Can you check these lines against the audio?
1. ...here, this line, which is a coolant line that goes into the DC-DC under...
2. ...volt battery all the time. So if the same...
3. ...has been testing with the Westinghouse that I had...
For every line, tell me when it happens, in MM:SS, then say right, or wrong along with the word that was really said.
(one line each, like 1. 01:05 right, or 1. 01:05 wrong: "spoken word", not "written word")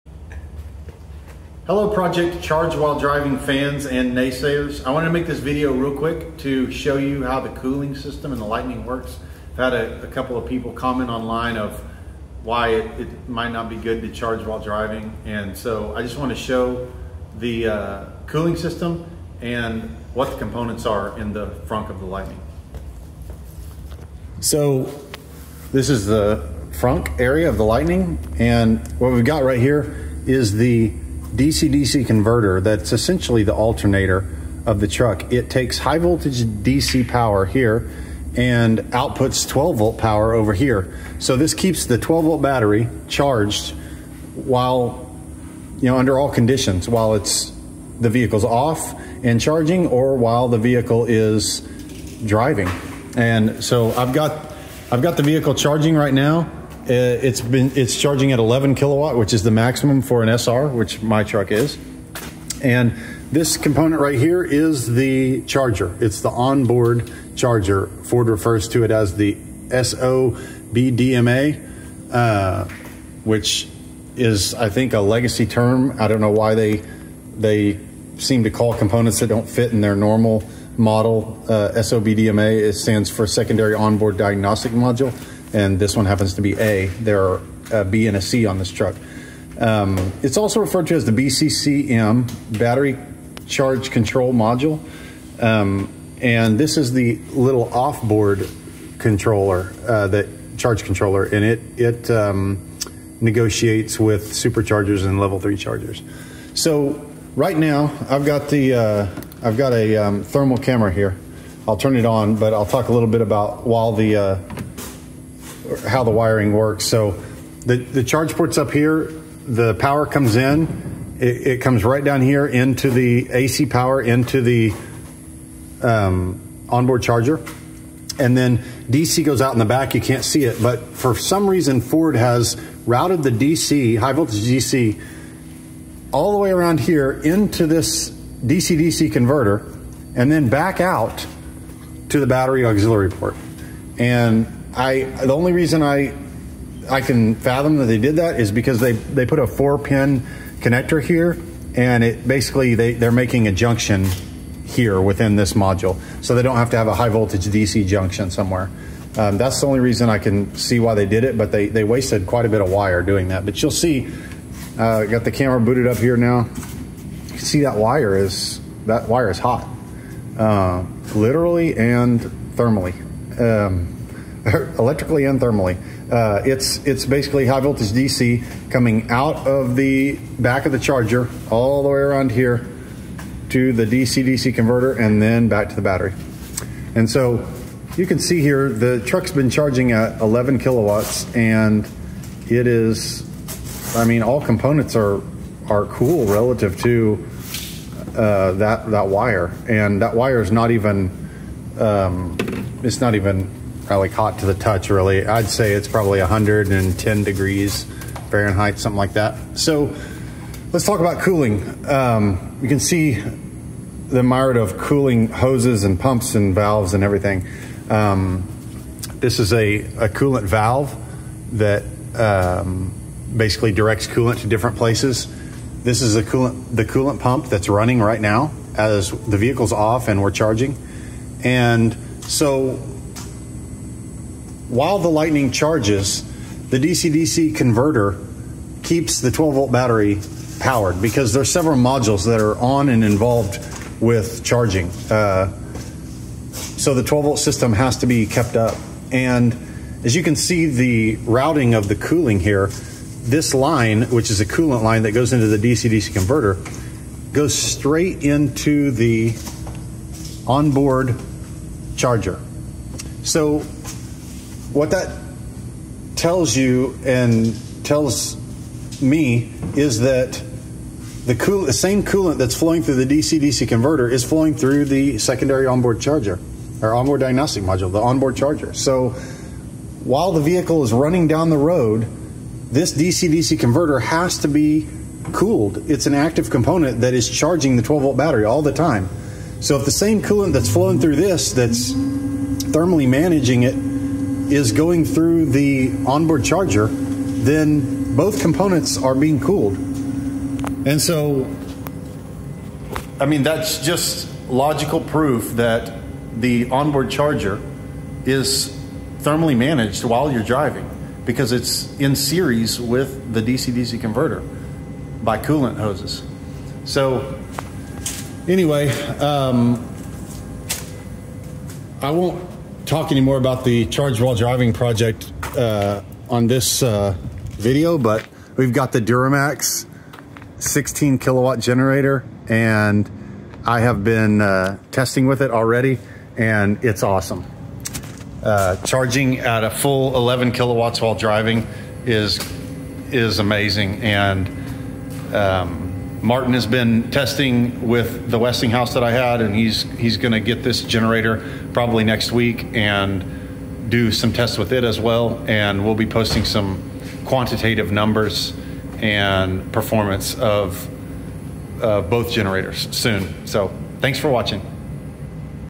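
1. 04:12 wrong: "converter", not "under"
2. 04:48 right
3. 05:46 right.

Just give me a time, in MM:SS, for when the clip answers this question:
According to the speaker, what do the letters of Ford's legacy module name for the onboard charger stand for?
01:23.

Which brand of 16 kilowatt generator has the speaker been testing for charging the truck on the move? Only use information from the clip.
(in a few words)
DuroMax.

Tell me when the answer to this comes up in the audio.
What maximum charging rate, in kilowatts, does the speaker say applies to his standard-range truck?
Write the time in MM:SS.
00:58.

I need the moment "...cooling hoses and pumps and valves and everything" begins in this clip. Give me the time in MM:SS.
03:34.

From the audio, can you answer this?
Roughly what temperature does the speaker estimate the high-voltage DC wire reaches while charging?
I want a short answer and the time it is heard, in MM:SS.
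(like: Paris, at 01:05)
110 degrees Fahrenheit, at 03:26.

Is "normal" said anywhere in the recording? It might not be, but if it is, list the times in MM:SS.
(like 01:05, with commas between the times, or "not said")
01:19.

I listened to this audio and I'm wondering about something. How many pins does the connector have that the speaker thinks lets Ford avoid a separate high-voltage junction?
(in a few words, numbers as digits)
4.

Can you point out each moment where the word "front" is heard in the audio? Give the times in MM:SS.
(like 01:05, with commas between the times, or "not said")
00:21, 00:26.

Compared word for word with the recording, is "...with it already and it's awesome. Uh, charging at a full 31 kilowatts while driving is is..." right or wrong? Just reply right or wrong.
wrong.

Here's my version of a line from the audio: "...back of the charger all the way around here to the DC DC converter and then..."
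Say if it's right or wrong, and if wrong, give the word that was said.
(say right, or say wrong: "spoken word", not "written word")
right.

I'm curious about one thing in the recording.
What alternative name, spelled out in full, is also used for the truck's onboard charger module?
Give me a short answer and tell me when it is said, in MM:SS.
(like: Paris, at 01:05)
Battery Charge Control Module, at 01:32.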